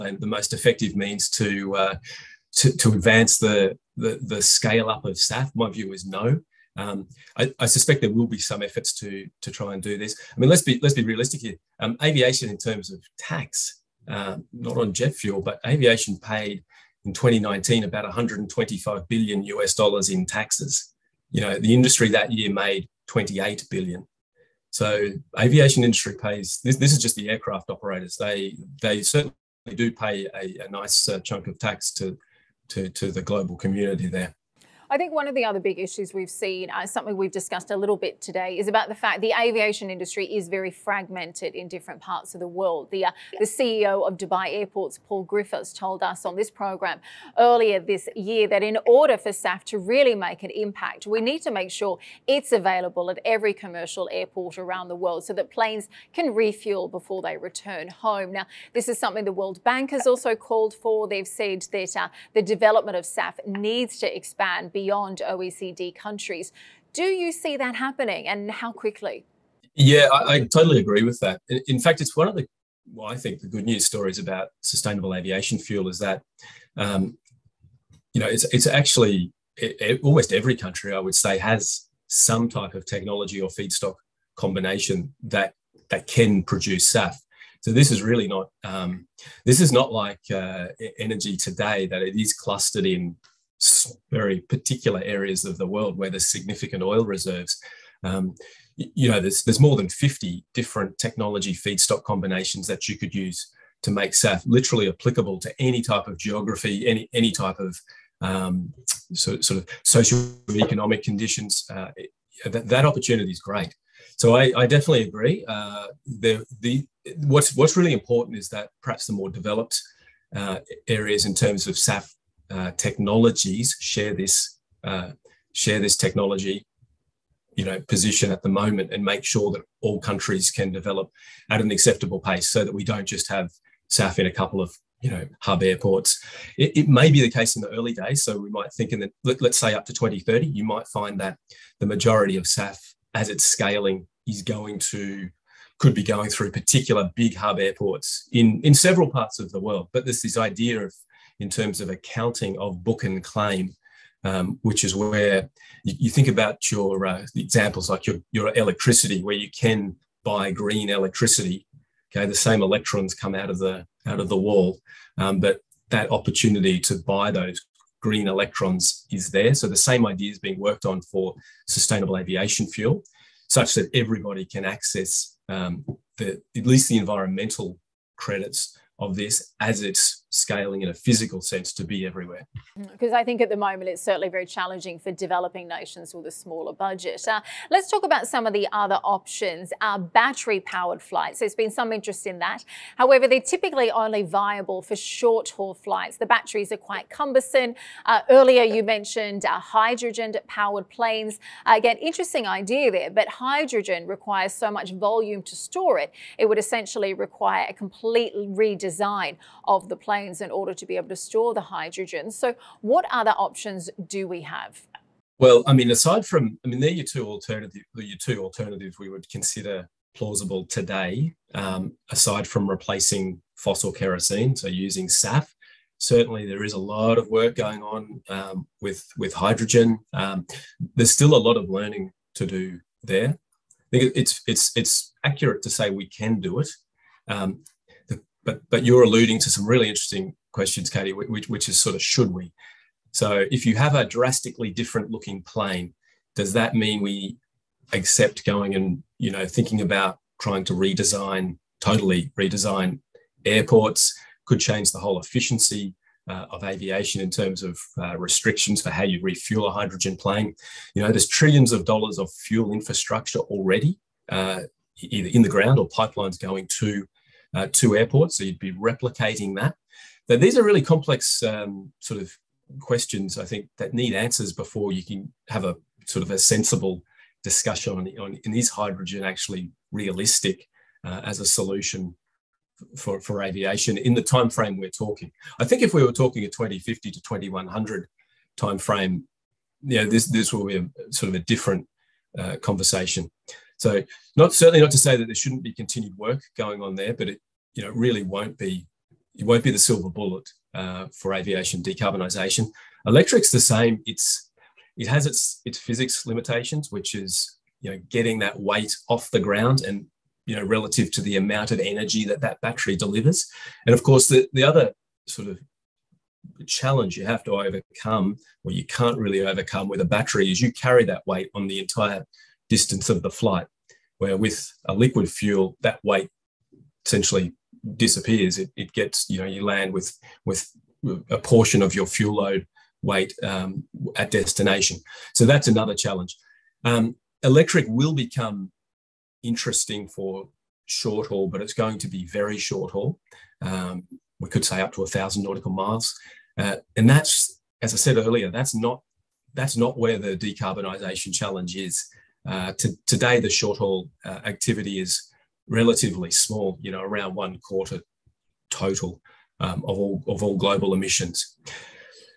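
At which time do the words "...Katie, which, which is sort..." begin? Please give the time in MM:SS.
04:00.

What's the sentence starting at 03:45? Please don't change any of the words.
Certainly, there is a lot of work going on um, with with hydrogen.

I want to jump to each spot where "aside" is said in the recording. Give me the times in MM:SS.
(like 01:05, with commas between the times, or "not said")
03:35, 03:42.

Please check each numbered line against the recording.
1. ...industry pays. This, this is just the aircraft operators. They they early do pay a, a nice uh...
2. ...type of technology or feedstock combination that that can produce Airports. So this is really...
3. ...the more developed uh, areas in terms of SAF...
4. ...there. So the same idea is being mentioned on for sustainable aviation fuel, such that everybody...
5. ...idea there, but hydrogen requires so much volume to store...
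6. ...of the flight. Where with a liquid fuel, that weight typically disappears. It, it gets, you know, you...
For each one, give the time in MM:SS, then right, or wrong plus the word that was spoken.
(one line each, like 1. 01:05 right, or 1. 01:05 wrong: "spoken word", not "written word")
1. 00:25 wrong: "certainly", not "early"
2. 01:22 wrong: "SAF", not "Airports"
3. 01:59 right
4. 02:49 wrong: "worked", not "mentioned"
5. 03:22 right
6. 05:23 wrong: "essentially", not "typically".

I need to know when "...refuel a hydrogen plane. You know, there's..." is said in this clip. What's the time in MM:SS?
04:19.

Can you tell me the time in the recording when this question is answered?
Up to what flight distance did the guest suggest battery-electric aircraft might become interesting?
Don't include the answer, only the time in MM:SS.
05:45.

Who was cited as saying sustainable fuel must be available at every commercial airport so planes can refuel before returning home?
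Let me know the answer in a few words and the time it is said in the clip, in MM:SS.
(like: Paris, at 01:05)
Paul Griffiths, at 00:45.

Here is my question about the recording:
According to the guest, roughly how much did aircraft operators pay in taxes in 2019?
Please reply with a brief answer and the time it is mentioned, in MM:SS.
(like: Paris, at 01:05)
125 billion US dollars, at 00:18.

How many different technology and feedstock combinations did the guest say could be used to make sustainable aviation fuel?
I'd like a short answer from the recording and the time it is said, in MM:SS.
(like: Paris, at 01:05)
more than 50, at 01:39.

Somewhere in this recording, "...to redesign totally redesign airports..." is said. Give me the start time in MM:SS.
04:10.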